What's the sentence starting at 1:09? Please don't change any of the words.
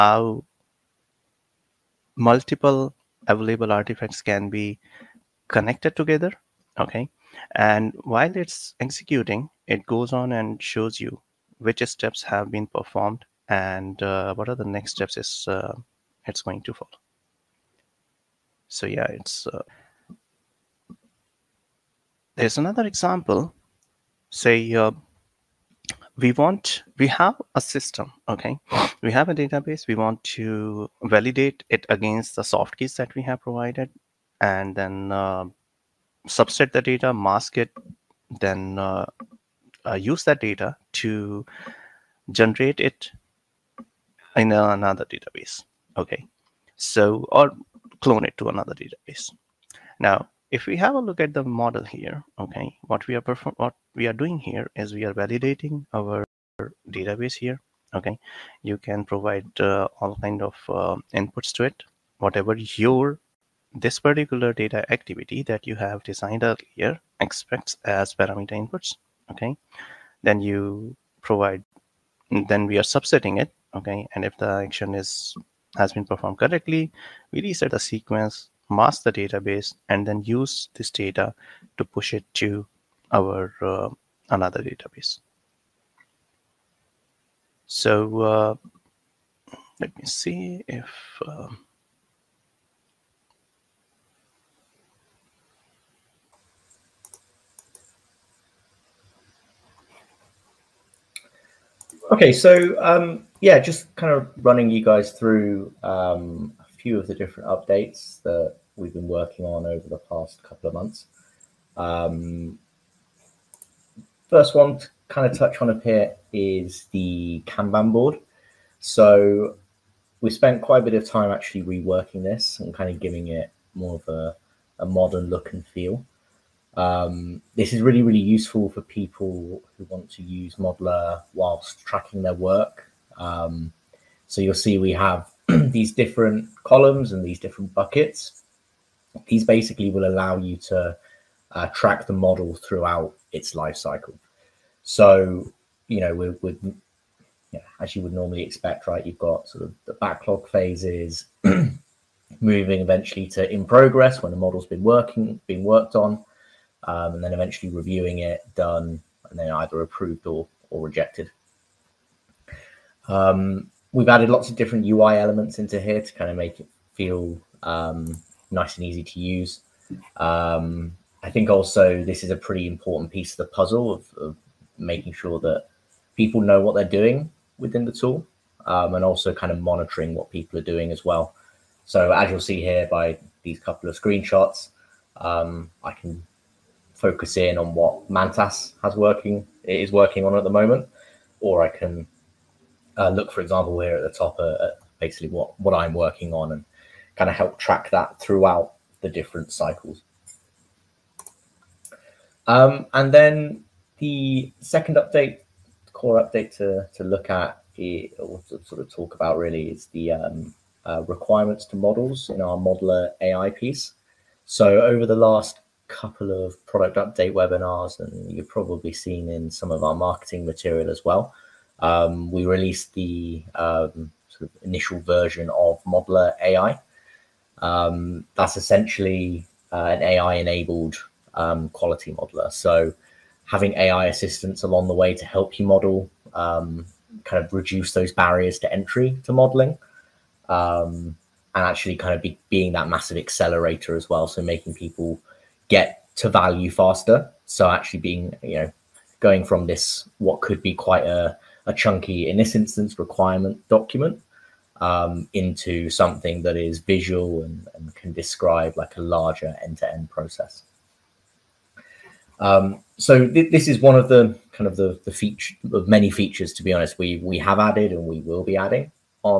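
Okay, then you provide, then we are subsetting it.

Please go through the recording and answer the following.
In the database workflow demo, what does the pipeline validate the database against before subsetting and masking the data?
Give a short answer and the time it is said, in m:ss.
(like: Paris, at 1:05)
soft keys, at 0:32.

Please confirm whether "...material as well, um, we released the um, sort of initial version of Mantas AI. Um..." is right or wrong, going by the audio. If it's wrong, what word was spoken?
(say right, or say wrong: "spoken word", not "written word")
wrong: "Modeler", not "Mantas".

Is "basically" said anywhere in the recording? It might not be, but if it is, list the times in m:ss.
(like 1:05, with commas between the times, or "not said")
2:19, 3:14.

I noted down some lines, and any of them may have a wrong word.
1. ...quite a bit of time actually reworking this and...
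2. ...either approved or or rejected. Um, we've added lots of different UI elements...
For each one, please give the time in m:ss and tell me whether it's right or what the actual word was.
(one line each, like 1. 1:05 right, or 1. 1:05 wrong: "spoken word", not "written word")
1. 2:00 right
2. 2:39 right.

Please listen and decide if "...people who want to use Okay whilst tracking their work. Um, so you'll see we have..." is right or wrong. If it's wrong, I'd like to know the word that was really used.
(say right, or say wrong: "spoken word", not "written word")
wrong: "Modeler", not "Okay".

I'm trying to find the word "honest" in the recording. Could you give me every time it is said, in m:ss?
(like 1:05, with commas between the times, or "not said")
4:26.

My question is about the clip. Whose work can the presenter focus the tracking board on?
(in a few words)
Mantas.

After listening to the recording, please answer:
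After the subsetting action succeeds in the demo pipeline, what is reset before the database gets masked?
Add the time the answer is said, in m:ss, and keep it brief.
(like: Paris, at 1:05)
the sequence, at 1:17.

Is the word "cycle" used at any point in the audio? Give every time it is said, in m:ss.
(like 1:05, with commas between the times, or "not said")
2:23, 3:19.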